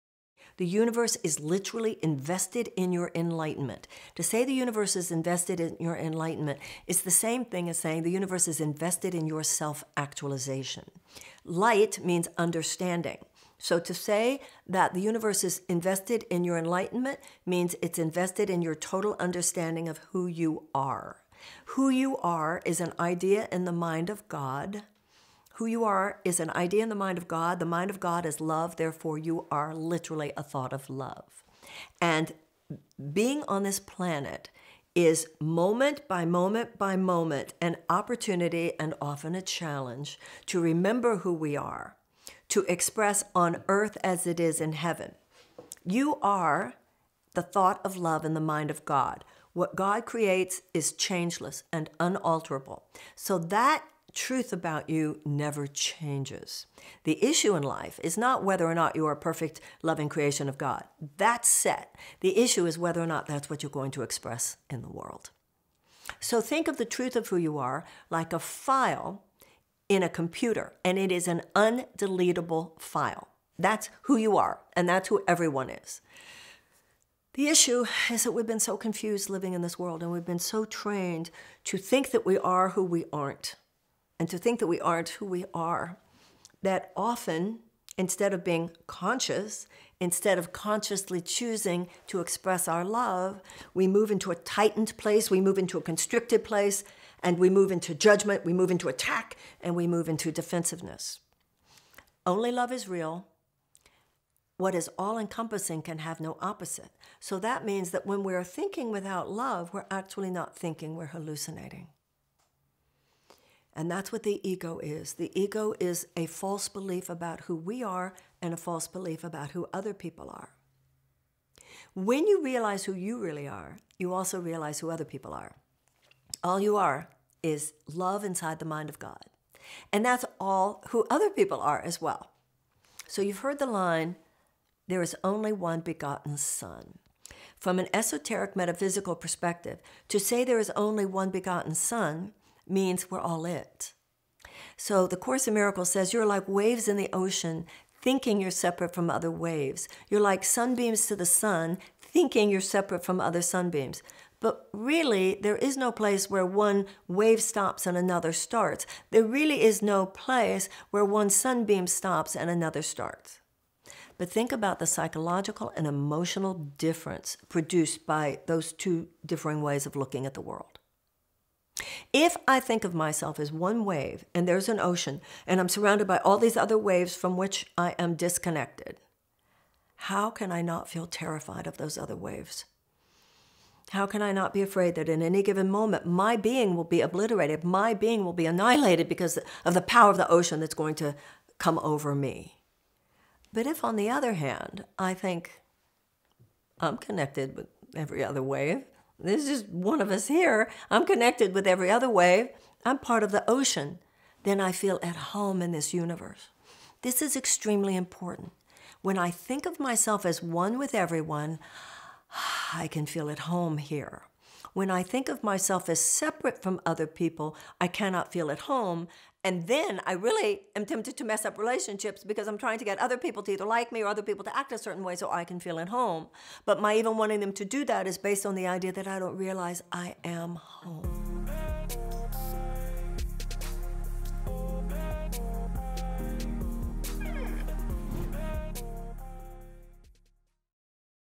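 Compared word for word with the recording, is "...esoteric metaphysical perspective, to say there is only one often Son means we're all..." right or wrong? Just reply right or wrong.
wrong.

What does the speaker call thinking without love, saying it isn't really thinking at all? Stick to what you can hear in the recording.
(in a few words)
hallucinating.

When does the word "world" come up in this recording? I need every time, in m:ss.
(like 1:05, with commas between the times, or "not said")
1:04, 1:19, 2:50.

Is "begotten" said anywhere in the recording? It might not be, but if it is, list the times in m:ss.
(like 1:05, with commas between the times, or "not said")
2:15, 2:21.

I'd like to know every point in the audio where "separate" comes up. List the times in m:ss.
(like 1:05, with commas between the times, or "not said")
2:28, 2:32, 3:35.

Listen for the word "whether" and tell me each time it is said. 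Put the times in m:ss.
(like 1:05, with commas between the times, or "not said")
0:58, 1:02.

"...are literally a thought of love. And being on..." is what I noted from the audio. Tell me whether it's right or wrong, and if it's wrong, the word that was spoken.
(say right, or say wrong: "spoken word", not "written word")
right.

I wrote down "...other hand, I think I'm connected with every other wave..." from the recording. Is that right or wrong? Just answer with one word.
right.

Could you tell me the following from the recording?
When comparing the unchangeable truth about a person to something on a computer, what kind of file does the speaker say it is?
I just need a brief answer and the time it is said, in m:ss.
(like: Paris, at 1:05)
undeletable file, at 1:11.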